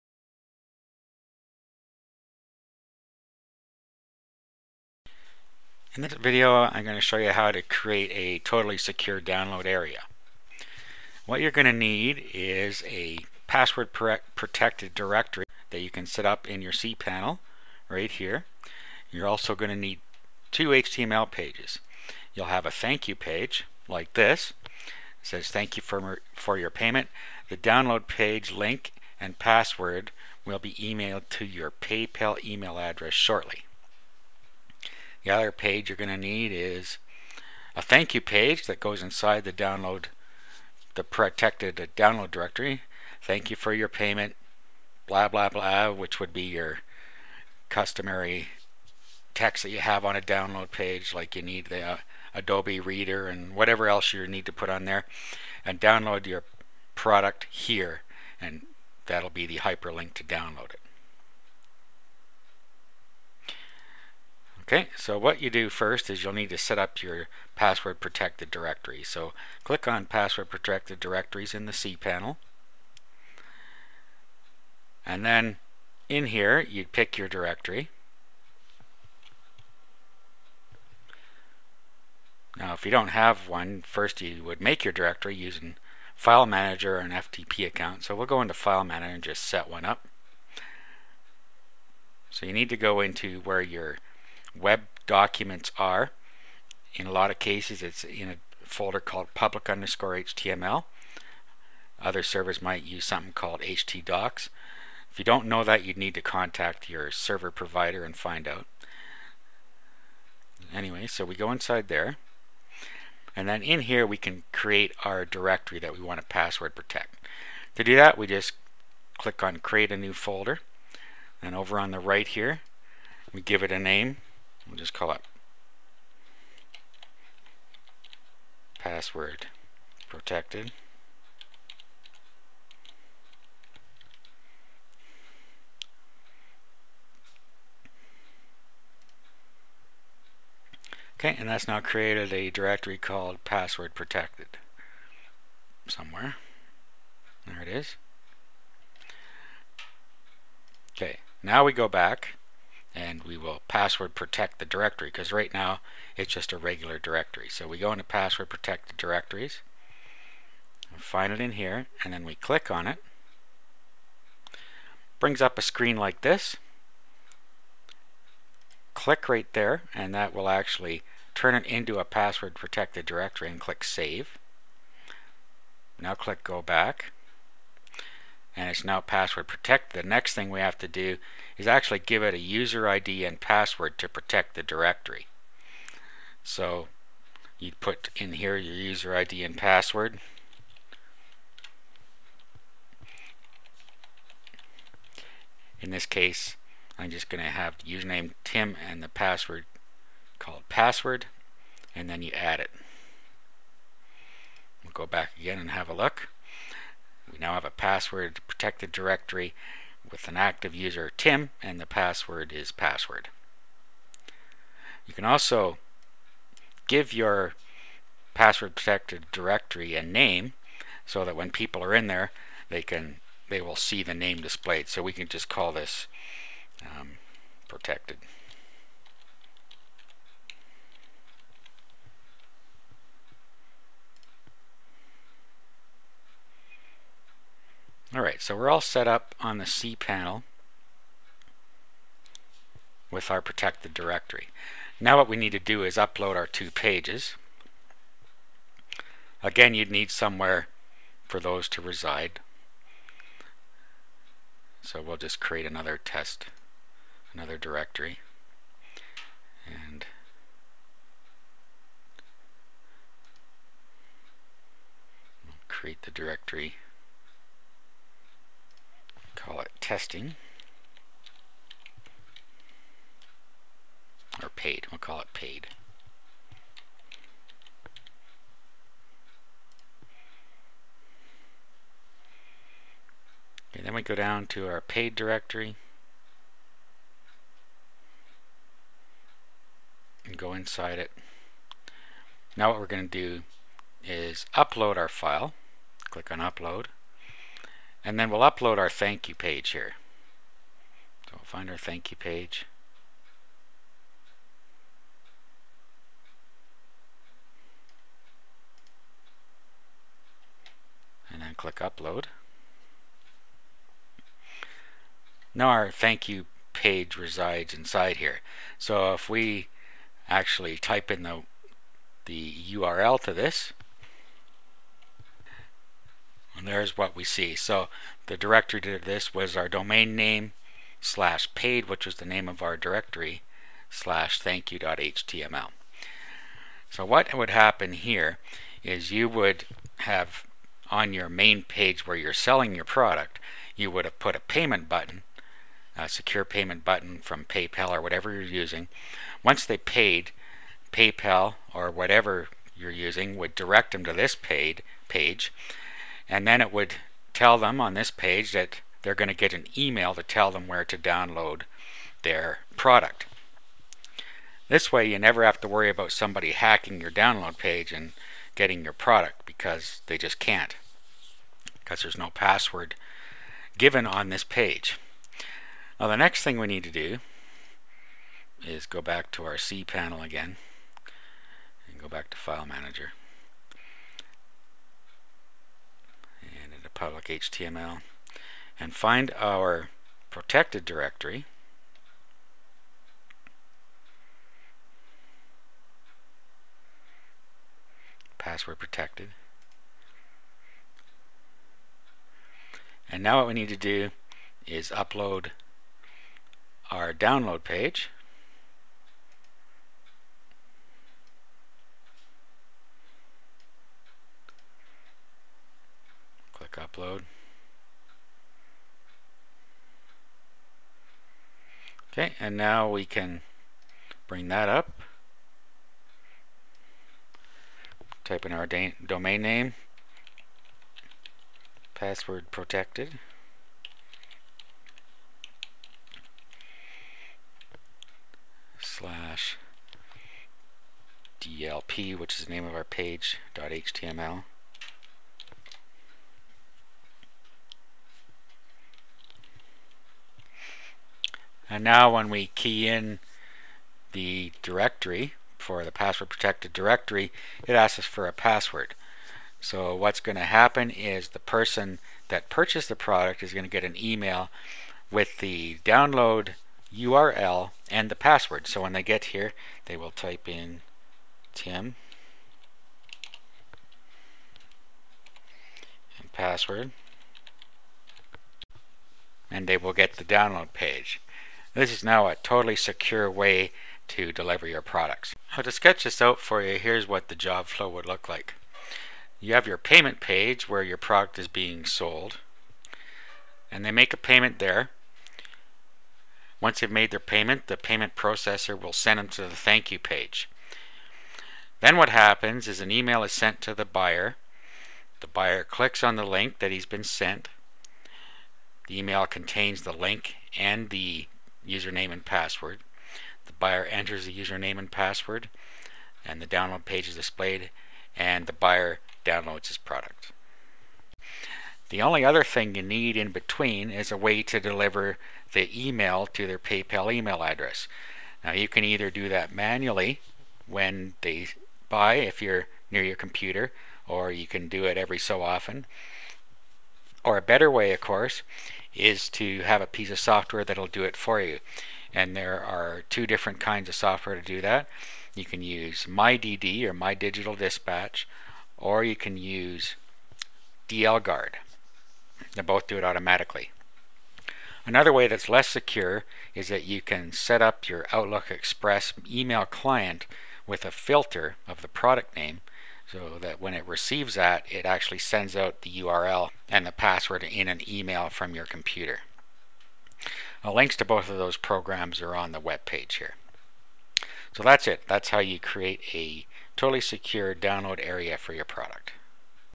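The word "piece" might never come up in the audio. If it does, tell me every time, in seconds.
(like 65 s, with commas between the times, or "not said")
539 s.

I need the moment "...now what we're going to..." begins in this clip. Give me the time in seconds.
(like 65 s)
292 s.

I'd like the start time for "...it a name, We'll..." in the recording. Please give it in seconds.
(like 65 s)
123 s.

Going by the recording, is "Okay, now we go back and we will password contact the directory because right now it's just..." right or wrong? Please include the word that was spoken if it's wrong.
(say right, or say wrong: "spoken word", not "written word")
wrong: "protect", not "contact".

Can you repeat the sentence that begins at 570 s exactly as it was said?
Now, links to both of those programs are on the web page here.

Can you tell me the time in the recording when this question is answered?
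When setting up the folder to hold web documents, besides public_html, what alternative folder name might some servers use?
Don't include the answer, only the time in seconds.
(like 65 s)
103 s.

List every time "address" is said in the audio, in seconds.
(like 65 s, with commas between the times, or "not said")
32 s, 527 s.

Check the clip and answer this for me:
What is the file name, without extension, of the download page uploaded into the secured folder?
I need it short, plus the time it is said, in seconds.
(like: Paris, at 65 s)
DLP, at 441 s.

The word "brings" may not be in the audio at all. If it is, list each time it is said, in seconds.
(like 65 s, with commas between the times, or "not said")
165 s, 424 s.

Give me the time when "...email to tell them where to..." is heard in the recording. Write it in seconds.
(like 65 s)
359 s.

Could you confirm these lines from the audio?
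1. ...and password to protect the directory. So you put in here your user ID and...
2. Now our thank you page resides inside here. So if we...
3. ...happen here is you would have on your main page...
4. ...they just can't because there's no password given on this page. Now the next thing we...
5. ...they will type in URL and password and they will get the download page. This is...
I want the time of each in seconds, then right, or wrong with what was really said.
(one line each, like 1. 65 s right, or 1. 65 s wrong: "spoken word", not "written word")
1. 183 s right
2. 315 s right
3. 337 s right
4. 370 s right
5. 469 s wrong: "Tim", not "URL".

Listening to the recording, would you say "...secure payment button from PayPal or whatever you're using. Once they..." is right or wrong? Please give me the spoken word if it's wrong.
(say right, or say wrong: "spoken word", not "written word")
right.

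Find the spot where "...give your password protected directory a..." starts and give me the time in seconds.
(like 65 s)
216 s.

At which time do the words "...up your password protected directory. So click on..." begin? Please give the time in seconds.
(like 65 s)
66 s.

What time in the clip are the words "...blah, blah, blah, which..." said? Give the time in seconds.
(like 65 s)
45 s.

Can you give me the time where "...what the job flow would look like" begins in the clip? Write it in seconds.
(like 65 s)
487 s.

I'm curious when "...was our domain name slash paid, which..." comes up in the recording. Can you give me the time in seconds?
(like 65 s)
329 s.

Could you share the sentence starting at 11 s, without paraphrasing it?
What you're going to need is a password protected directory that you can set up in your cPanel right here.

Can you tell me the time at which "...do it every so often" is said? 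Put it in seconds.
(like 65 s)
534 s.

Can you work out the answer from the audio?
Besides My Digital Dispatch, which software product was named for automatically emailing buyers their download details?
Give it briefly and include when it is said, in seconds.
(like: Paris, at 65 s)
DLGuard, at 550 s.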